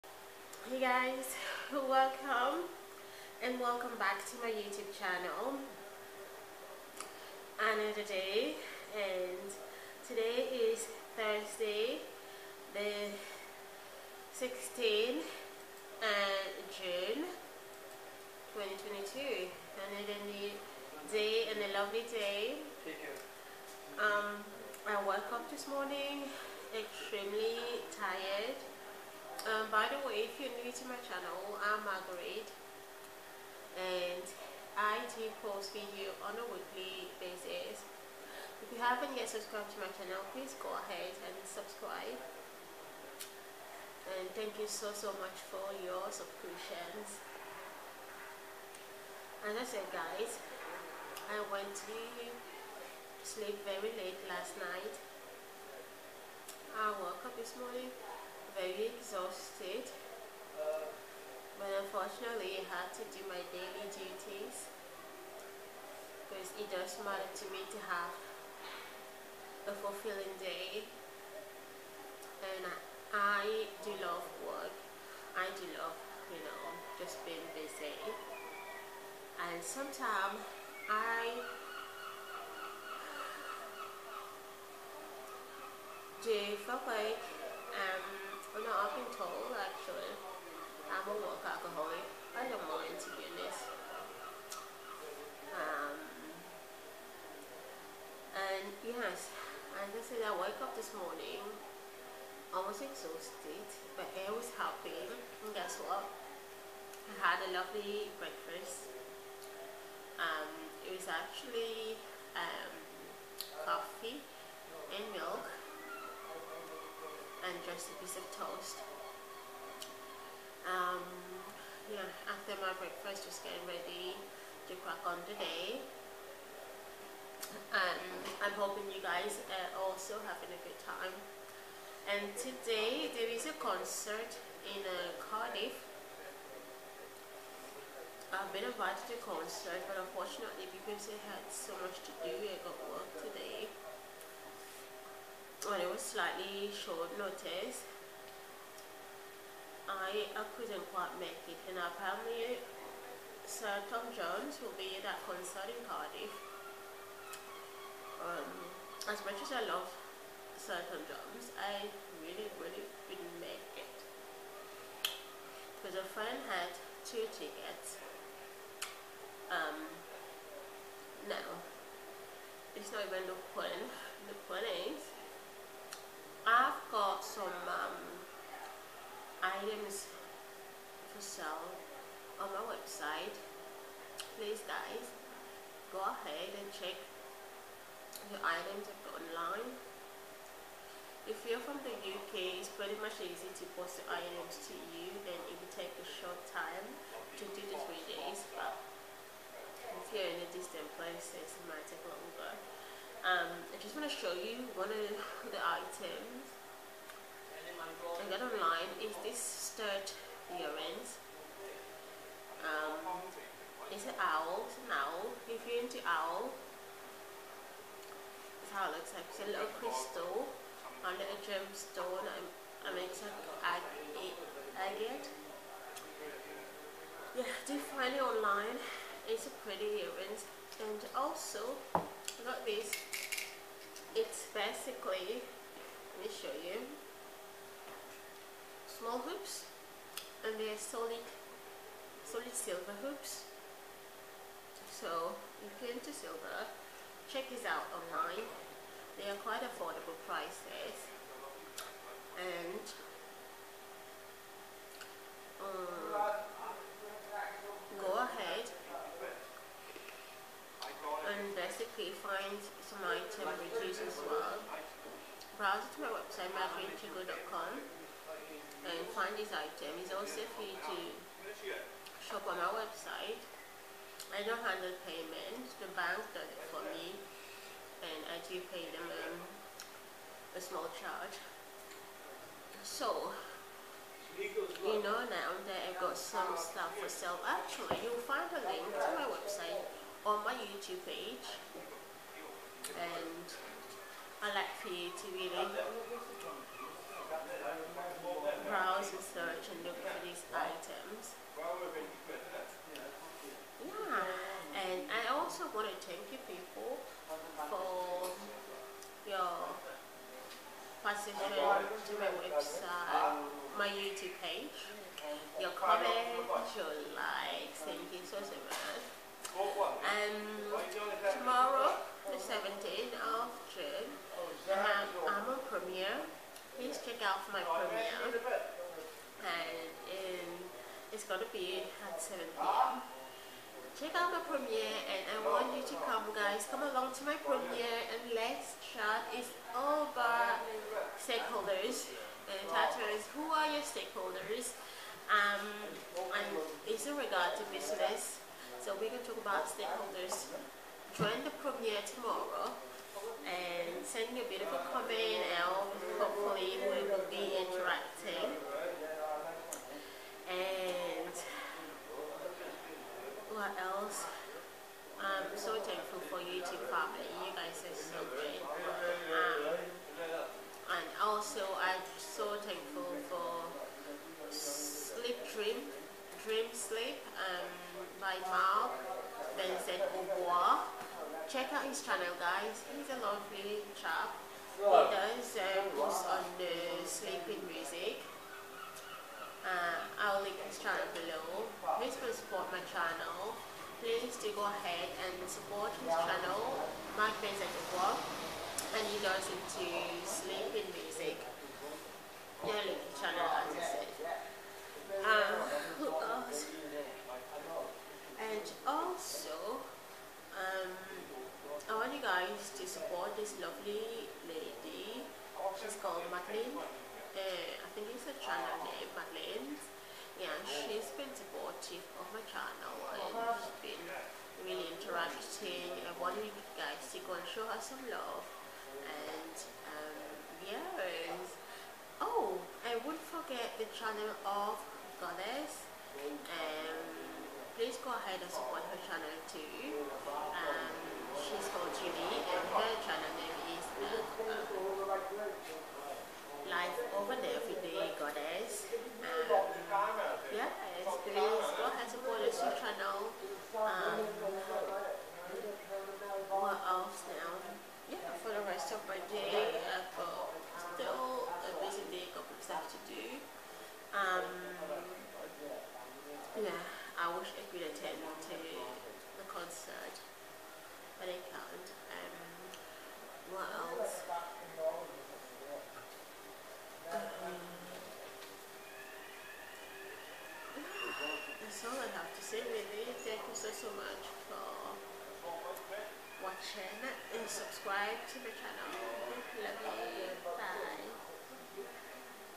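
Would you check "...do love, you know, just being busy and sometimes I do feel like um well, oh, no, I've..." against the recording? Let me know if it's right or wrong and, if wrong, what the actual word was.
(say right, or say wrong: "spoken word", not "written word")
right.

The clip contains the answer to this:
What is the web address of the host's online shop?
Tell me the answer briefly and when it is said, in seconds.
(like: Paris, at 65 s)
myfriendchigo.com, at 266 s.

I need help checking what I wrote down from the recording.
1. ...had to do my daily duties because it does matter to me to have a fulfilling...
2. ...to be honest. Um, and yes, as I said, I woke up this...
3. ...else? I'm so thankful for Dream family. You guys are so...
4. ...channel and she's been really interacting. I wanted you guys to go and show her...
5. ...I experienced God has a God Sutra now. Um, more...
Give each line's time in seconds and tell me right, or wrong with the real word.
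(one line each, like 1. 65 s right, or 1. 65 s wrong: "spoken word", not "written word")
1. 62 s right
2. 92 s right
3. 363 s wrong: "YouTube", not "Dream"
4. 422 s right
5. 450 s wrong: "Buddha", not "God".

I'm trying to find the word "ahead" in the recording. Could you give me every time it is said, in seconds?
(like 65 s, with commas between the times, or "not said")
40 s, 186 s, 394 s, 438 s.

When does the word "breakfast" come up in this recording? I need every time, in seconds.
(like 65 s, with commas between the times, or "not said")
108 s, 122 s.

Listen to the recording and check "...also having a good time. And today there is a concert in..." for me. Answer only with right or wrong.
right.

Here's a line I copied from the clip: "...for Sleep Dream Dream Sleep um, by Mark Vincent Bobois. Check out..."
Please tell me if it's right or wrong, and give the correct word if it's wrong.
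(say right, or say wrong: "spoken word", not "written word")
right.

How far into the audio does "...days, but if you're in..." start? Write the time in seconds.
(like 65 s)
198 s.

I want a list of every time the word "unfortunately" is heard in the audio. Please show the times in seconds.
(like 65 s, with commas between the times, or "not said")
61 s, 139 s.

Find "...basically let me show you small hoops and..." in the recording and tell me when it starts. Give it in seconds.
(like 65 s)
234 s.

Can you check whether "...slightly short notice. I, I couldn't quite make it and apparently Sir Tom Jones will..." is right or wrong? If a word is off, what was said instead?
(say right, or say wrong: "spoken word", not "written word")
right.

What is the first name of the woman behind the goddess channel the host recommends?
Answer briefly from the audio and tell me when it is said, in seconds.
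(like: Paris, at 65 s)
Julie, at 442 s.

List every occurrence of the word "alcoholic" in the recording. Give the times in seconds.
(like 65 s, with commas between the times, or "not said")
91 s.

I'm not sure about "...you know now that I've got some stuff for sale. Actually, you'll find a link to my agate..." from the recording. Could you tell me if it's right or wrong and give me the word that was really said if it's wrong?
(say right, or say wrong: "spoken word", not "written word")
wrong: "website", not "agate".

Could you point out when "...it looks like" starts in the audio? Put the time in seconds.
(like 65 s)
218 s.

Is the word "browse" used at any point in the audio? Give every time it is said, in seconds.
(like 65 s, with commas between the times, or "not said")
265 s, 298 s.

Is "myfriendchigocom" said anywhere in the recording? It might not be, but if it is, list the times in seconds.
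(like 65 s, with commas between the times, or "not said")
266 s.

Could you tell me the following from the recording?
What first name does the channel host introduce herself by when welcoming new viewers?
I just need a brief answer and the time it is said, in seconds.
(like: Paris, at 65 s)
Margaret, at 31 s.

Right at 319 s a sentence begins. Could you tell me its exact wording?
Um, tomorrow, the 17th of June, um, i have on premiere.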